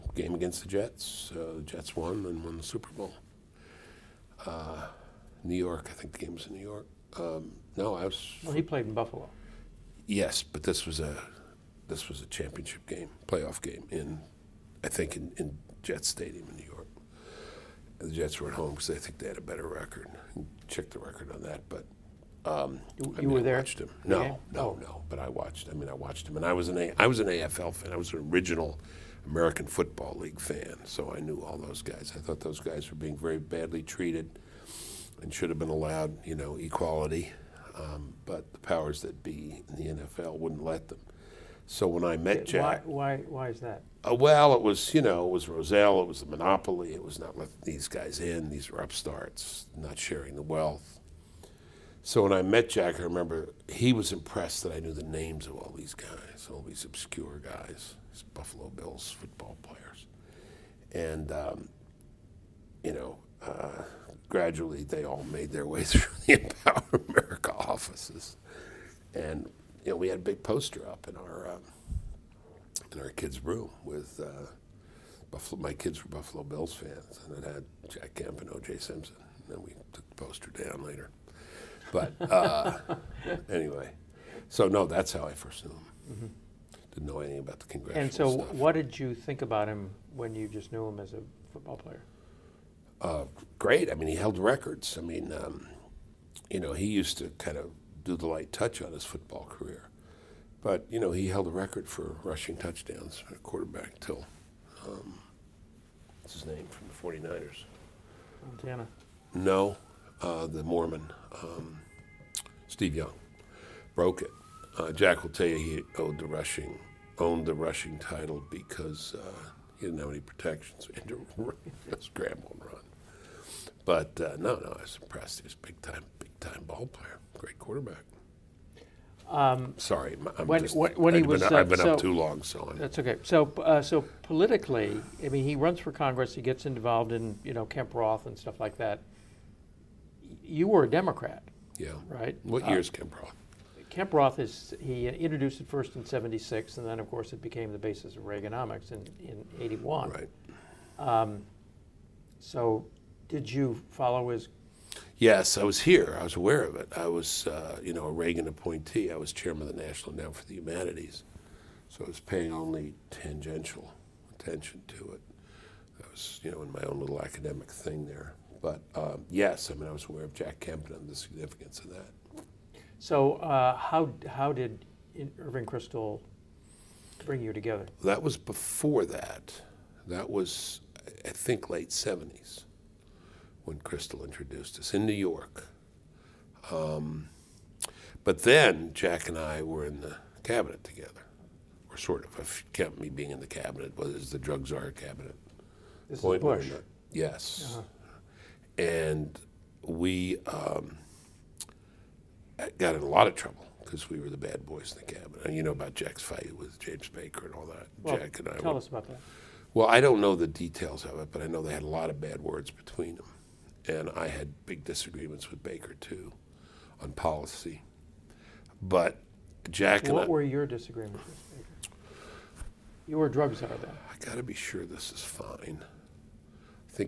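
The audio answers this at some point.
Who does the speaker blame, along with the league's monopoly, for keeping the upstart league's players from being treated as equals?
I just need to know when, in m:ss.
0:45.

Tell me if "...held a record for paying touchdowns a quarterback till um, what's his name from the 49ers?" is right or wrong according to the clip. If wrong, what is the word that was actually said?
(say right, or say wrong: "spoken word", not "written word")
wrong: "rushing", not "paying".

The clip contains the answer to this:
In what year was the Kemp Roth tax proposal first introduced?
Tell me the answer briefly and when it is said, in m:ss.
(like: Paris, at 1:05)
1976, at 2:26.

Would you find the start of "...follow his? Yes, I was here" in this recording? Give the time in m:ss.
2:33.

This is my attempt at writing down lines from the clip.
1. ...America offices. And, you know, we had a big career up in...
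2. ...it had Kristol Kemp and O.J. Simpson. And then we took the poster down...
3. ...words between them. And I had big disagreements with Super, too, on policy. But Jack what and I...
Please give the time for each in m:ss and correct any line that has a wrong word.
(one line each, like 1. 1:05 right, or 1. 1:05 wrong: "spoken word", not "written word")
1. 1:07 wrong: "poster", not "career"
2. 1:17 wrong: "Jack", not "Kristol"
3. 3:32 wrong: "Baker", not "Super".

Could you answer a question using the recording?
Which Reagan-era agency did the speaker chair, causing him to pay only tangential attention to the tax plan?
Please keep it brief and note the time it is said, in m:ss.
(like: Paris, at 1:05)
National Endowment for the Humanities, at 2:39.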